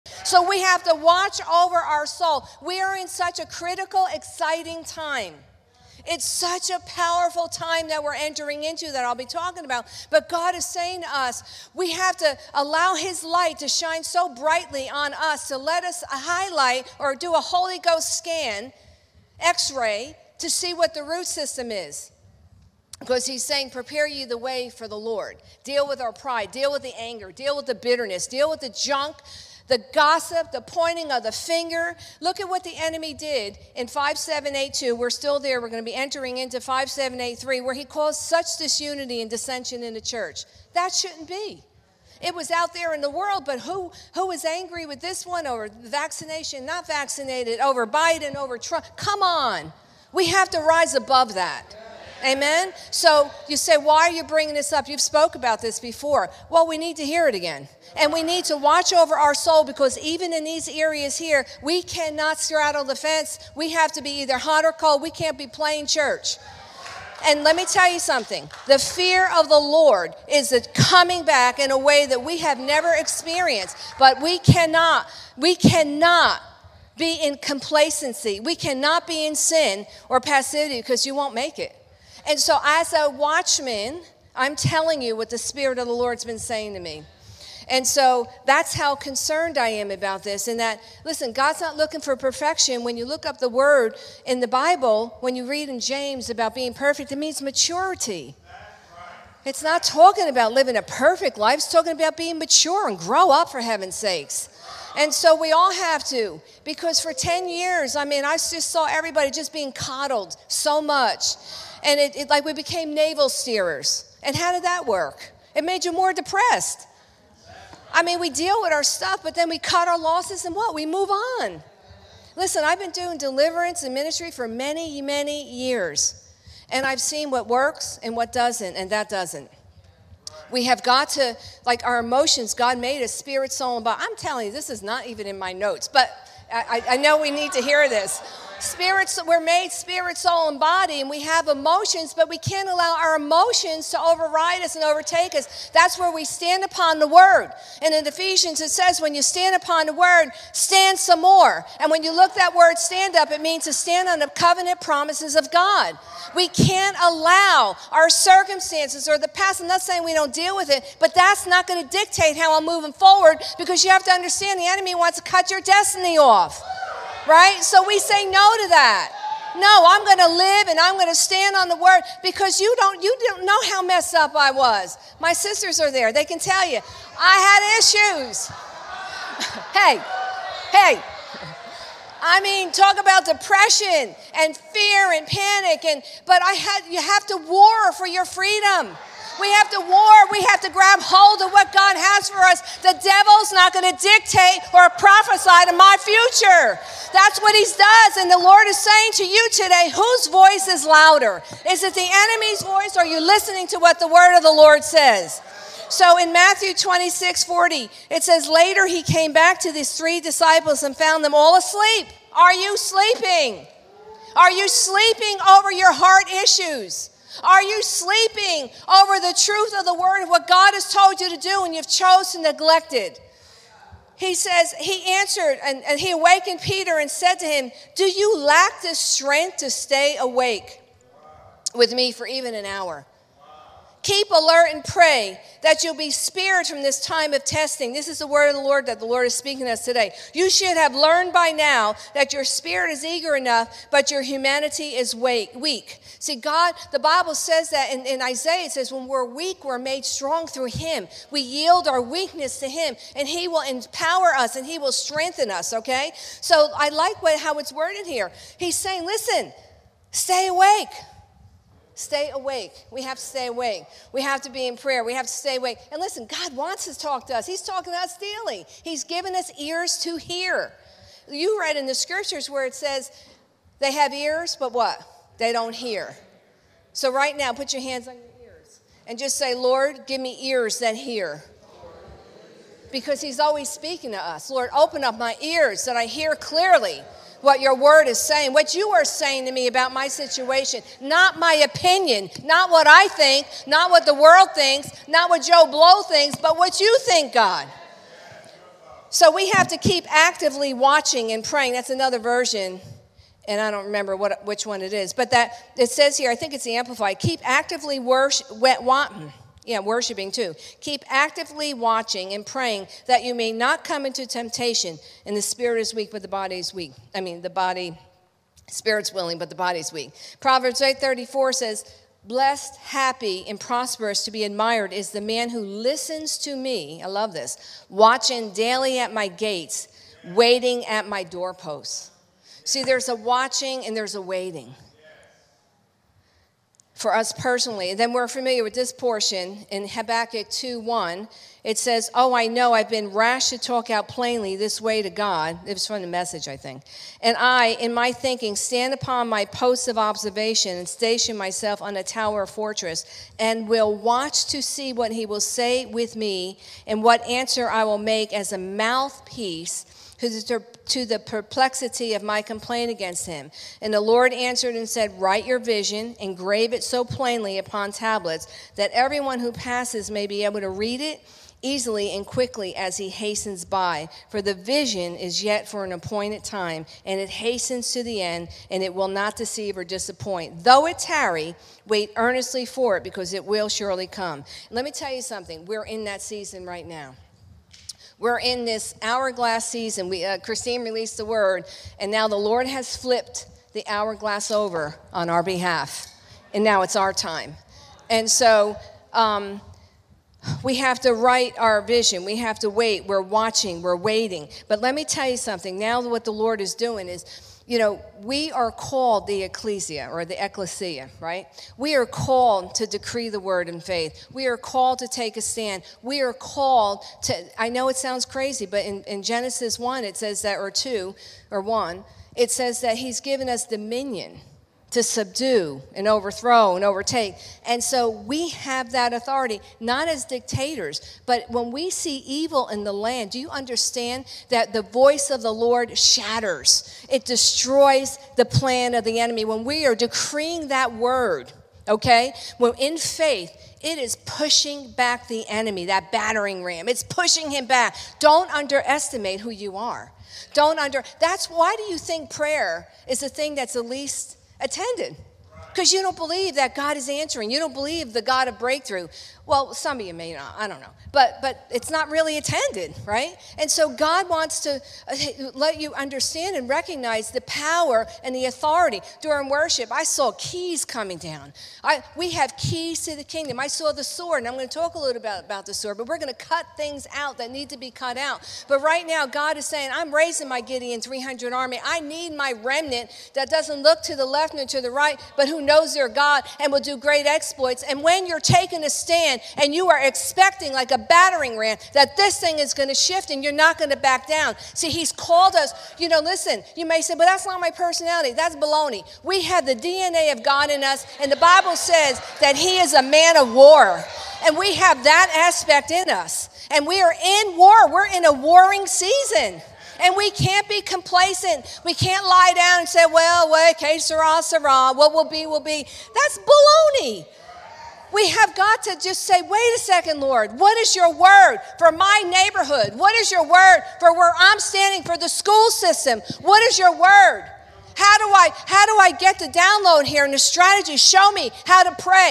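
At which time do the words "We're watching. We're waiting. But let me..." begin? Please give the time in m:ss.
6:43.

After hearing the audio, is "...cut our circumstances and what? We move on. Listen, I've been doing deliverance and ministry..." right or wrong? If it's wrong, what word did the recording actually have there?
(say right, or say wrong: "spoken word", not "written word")
wrong: "losses", not "circumstances".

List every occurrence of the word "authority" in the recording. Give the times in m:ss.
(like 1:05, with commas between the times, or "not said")
7:09, 7:48.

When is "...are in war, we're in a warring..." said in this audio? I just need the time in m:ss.
8:27.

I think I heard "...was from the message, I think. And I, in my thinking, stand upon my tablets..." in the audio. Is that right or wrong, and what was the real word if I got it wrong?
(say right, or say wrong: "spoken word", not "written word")
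wrong: "posts", not "tablets".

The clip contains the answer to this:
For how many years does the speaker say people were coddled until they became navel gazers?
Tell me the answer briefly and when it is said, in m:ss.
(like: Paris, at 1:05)
10, at 1:47.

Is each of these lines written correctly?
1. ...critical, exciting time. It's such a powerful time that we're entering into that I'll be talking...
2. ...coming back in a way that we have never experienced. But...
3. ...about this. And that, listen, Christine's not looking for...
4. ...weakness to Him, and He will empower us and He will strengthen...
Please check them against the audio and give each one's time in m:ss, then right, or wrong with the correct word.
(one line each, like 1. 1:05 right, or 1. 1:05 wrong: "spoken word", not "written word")
1. 0:03 right
2. 1:10 right
3. 1:29 wrong: "God", not "Christine"
4. 4:12 right.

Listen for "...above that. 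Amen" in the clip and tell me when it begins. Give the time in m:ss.
0:50.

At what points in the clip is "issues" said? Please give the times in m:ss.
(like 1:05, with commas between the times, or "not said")
2:58, 3:36.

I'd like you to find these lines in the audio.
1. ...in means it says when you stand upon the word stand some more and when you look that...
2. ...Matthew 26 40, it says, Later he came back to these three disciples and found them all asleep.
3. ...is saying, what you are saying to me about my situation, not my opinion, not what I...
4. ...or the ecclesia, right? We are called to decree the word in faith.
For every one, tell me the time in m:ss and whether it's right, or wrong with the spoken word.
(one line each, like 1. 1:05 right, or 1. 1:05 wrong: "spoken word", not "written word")
1. 2:27 wrong: "ephesians", not "means"
2. 3:26 right
3. 4:48 right
4. 6:50 right.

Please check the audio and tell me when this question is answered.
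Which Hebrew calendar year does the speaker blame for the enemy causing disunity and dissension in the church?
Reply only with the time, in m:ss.
0:33.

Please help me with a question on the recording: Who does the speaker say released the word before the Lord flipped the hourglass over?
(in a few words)
Christine.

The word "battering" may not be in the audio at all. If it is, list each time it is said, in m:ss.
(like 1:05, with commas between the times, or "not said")
7:26, 8:10.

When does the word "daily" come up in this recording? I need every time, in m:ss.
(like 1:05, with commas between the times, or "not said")
4:28, 5:28.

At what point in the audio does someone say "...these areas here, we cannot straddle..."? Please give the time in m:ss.
1:00.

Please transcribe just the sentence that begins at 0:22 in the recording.
Because he's saying, prepare you the way for the Lord.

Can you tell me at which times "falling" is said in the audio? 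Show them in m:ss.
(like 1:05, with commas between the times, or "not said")
not said.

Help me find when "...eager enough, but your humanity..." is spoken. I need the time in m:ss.
4:03.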